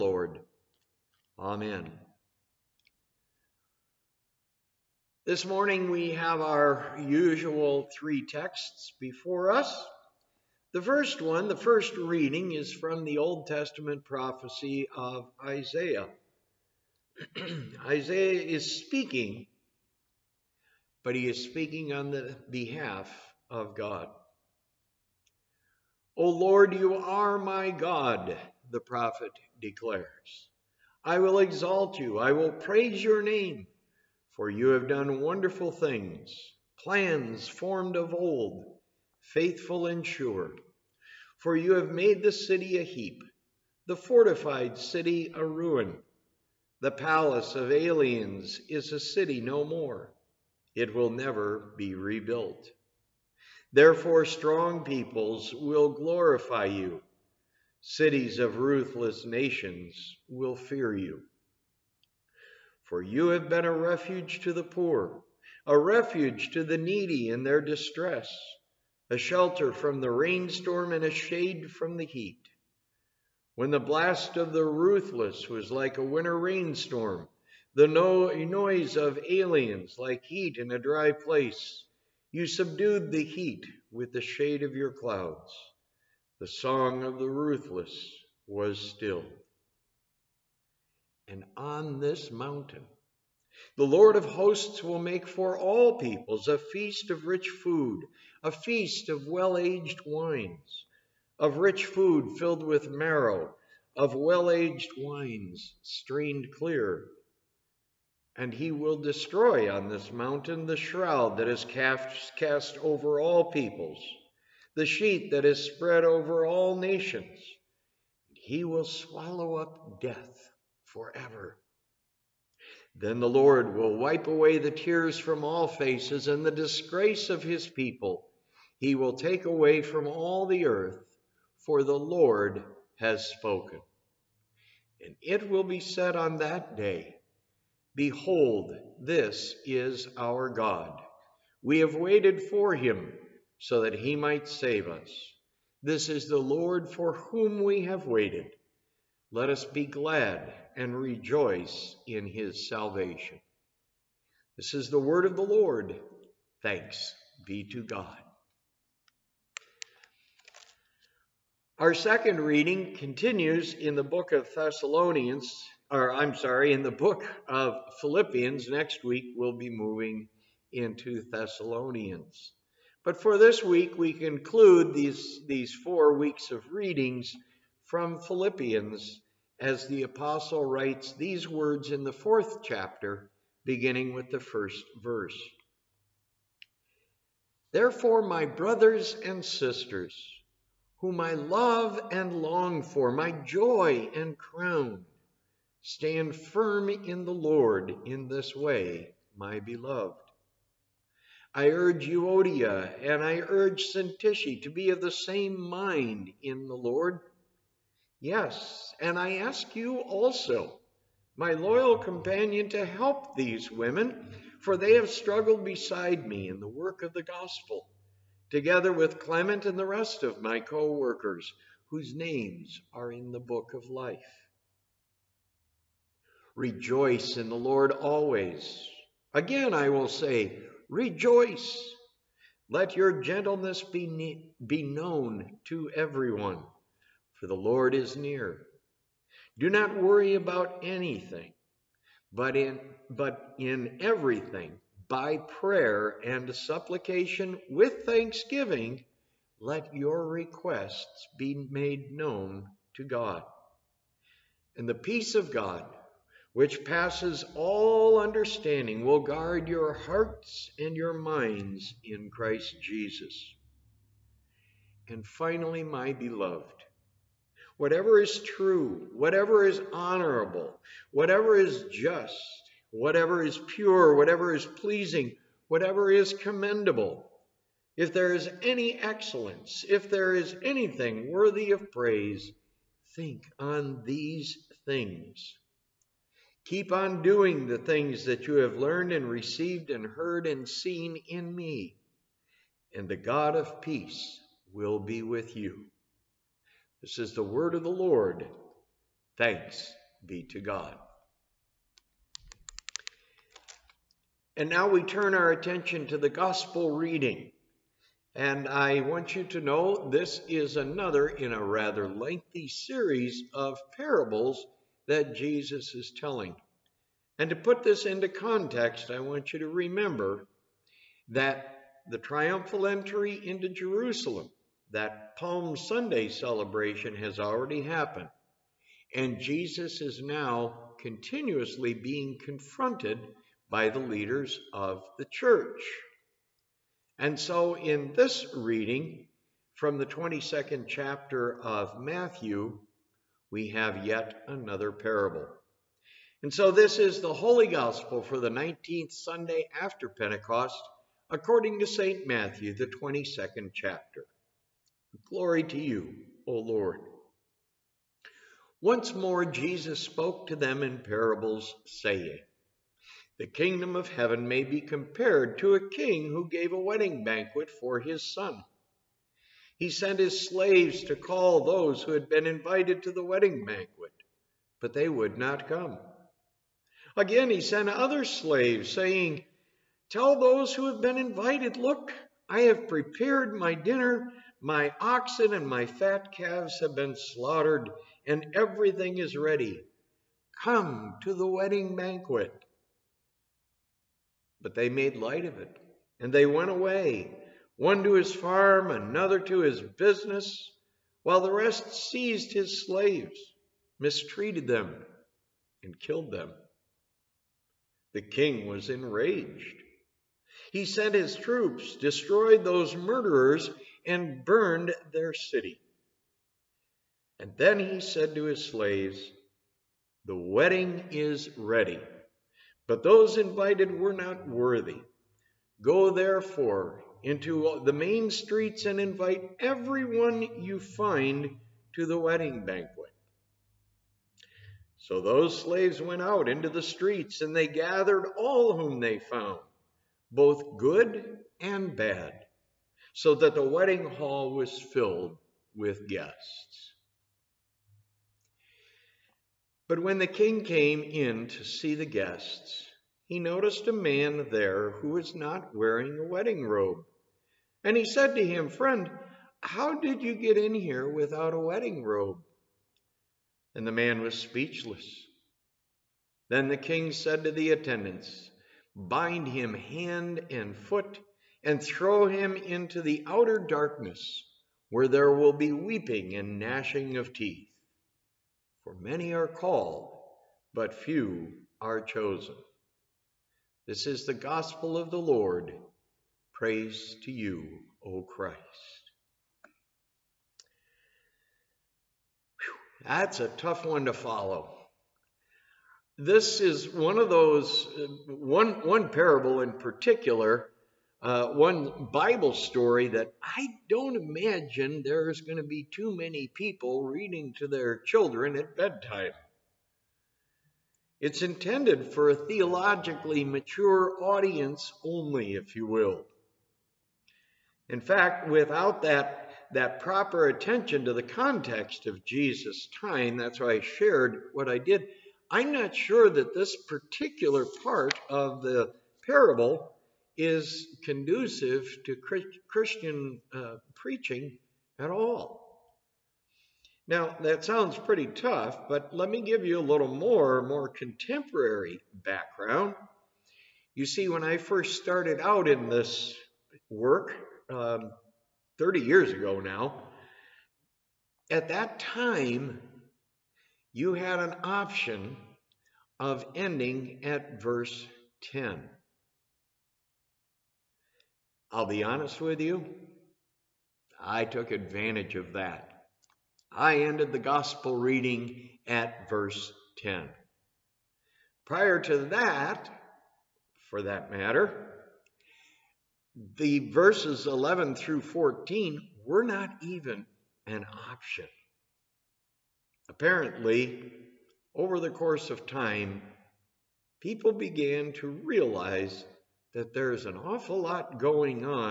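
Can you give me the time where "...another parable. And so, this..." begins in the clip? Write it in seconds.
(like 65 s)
344 s.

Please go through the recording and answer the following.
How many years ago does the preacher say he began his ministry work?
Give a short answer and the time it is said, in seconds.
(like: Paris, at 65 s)
30, at 548 s.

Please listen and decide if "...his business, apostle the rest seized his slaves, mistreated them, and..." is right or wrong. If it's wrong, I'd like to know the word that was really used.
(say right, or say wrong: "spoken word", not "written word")
wrong: "while", not "apostle".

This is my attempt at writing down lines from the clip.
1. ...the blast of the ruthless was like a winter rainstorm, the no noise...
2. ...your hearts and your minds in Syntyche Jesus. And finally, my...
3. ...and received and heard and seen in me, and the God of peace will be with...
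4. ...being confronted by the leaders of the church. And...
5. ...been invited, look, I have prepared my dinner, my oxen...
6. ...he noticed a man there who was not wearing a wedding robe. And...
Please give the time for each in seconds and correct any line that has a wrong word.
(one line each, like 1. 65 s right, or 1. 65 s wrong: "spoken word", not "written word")
1. 73 s right
2. 259 s wrong: "Christ", not "Syntyche"
3. 289 s right
4. 331 s right
5. 381 s right
6. 453 s right.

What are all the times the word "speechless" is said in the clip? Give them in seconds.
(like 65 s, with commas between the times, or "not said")
464 s.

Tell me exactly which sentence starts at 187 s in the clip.
Therefore, my brothers and sisters, whom I love and long for, my joy and crown.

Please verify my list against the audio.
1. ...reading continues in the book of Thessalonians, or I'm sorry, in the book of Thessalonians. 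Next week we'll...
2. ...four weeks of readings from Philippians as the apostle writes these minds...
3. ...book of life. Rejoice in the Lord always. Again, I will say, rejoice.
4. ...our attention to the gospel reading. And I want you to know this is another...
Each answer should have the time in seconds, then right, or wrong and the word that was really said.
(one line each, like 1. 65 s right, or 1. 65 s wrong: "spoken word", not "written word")
1. 162 s wrong: "Philippians", not "Thessalonians"
2. 175 s wrong: "words", not "minds"
3. 223 s right
4. 305 s right.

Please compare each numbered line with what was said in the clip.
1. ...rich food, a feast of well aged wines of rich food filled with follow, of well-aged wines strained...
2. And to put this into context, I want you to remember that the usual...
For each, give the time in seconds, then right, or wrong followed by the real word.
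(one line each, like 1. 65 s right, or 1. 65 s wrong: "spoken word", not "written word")
1. 97 s wrong: "marrow", not "follow"
2. 317 s wrong: "triumphal", not "usual".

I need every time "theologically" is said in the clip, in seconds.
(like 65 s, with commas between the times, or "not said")
512 s.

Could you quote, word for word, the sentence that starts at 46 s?
The palace of aliens is a city no more.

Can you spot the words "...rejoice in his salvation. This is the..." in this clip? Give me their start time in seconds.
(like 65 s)
150 s.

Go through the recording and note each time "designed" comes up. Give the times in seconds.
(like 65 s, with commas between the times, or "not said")
not said.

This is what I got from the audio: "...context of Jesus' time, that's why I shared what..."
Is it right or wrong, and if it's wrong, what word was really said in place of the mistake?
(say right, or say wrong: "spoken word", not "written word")
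right.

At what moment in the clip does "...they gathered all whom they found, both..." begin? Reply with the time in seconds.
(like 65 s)
437 s.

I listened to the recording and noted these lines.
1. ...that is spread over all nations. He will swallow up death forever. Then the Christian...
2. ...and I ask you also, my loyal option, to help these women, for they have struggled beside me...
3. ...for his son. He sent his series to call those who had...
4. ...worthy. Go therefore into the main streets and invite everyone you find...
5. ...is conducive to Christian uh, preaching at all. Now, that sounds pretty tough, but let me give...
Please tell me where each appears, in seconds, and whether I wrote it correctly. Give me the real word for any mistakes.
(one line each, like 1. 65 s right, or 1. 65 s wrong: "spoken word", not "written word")
1. 115 s wrong: "Lord", not "Christian"
2. 208 s wrong: "companion", not "option"
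3. 367 s wrong: "slaves", not "series"
4. 424 s right
5. 530 s right.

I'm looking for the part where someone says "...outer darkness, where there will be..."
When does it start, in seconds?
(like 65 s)
473 s.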